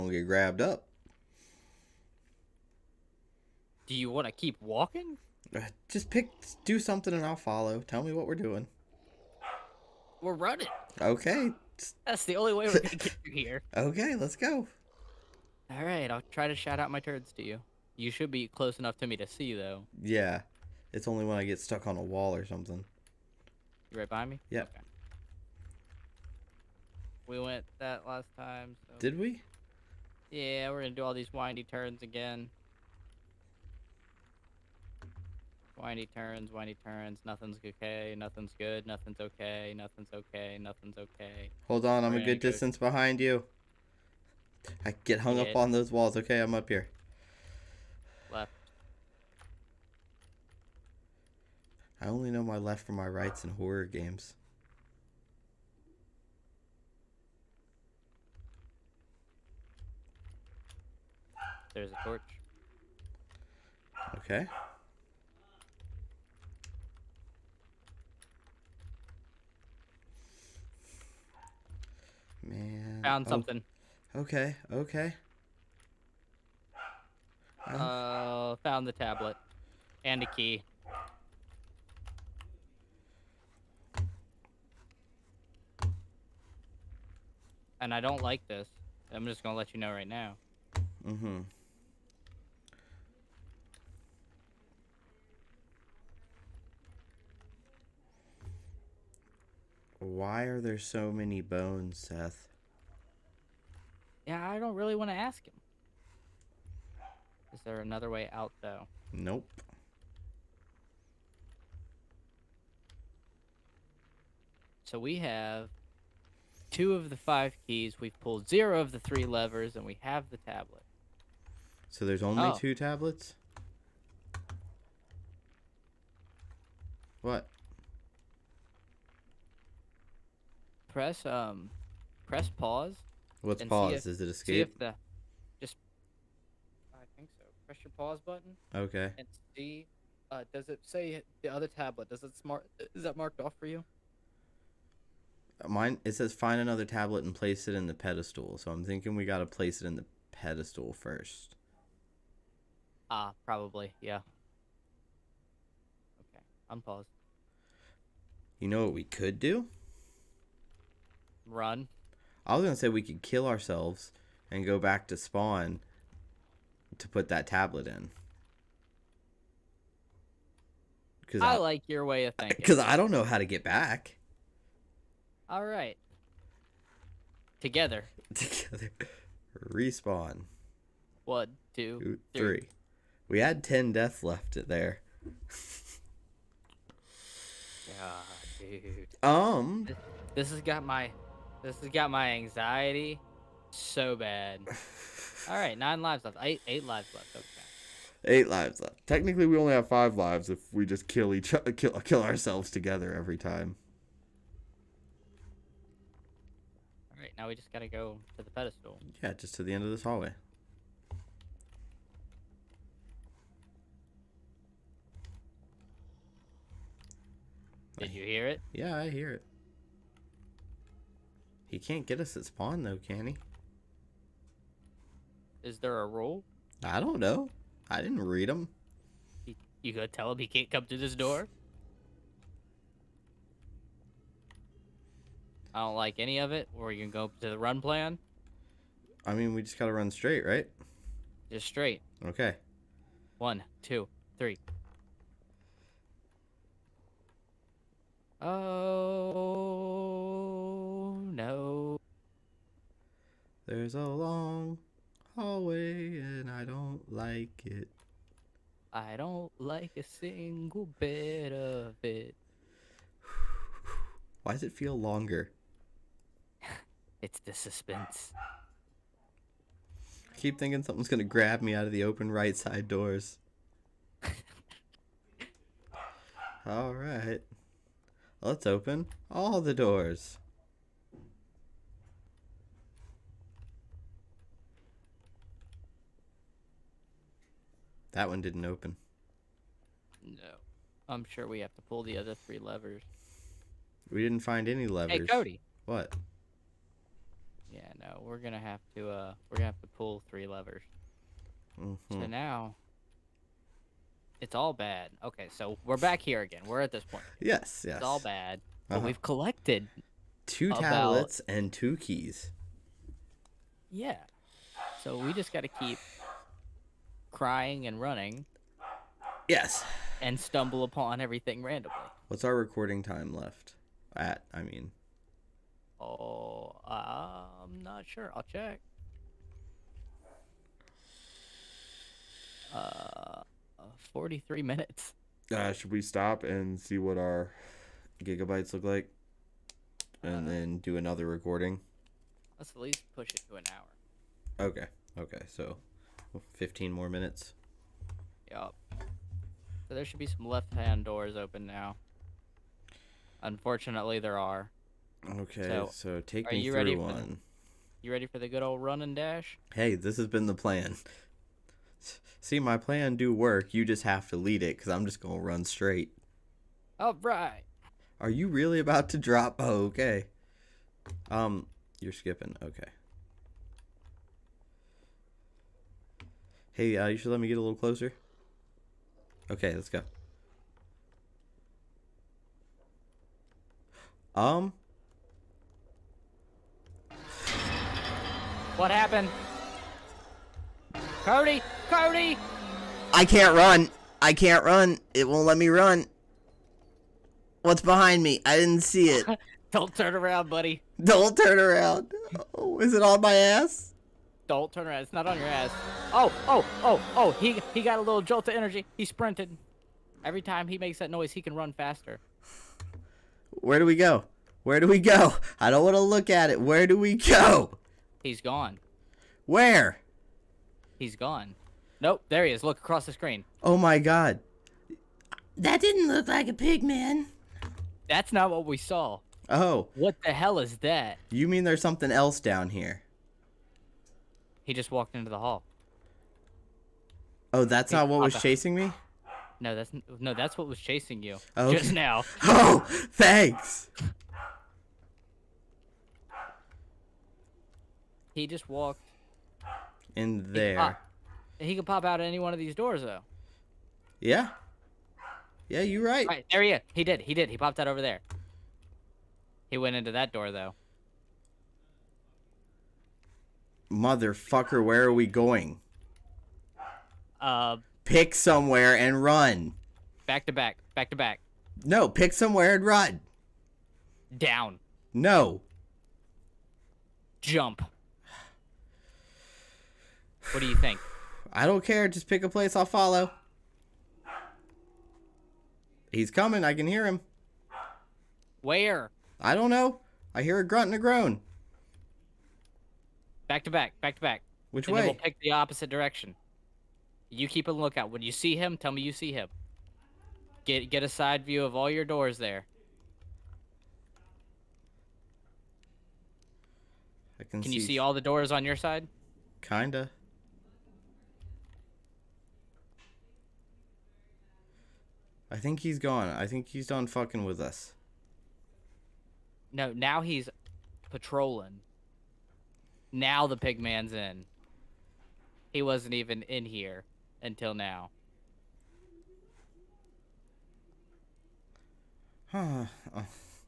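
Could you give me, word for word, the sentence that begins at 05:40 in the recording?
And uh, then do another recording?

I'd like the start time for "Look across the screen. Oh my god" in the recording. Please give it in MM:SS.
07:02.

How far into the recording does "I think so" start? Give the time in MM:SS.
02:16.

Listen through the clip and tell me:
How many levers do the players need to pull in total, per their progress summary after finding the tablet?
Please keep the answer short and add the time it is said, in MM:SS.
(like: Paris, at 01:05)
3, at 01:58.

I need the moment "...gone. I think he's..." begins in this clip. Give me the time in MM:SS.
08:35.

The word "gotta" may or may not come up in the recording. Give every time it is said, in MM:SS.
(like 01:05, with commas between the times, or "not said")
02:29, 03:27, 03:59.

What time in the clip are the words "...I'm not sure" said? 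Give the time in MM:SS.
05:26.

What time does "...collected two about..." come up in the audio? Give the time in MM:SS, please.
05:09.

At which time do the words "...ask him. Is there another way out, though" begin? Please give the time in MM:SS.
01:45.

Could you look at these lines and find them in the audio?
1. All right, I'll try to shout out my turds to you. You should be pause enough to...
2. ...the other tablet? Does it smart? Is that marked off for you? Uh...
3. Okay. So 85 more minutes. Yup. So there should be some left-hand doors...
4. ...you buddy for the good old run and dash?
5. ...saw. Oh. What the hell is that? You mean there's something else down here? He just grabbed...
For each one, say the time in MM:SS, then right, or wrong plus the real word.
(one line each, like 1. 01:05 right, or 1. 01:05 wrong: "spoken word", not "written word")
1. 00:15 wrong: "close", not "pause"
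2. 02:21 right
3. 05:45 wrong: "15", not "85"
4. 05:58 wrong: "ready", not "buddy"
5. 07:08 wrong: "walked", not "grabbed".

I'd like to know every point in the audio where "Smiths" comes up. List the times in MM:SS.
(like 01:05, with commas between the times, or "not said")
not said.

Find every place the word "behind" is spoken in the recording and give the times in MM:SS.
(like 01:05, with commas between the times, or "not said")
00:42, 06:37.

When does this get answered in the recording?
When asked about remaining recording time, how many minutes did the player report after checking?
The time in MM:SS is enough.
05:32.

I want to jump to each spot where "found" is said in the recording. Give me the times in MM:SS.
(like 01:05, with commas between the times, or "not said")
01:13, 01:18.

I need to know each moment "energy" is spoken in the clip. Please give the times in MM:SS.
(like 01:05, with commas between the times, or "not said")
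06:48.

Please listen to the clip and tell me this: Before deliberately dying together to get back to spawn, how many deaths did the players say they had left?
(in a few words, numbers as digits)
10.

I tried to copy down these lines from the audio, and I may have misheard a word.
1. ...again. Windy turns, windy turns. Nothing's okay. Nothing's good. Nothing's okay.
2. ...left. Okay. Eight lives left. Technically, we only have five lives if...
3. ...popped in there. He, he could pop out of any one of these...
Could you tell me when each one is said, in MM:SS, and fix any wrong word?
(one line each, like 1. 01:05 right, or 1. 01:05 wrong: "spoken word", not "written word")
1. 00:32 right
2. 03:17 right
3. 07:28 wrong: "walked", not "popped".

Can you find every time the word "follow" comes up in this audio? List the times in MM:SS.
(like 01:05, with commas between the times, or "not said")
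00:07, 08:02.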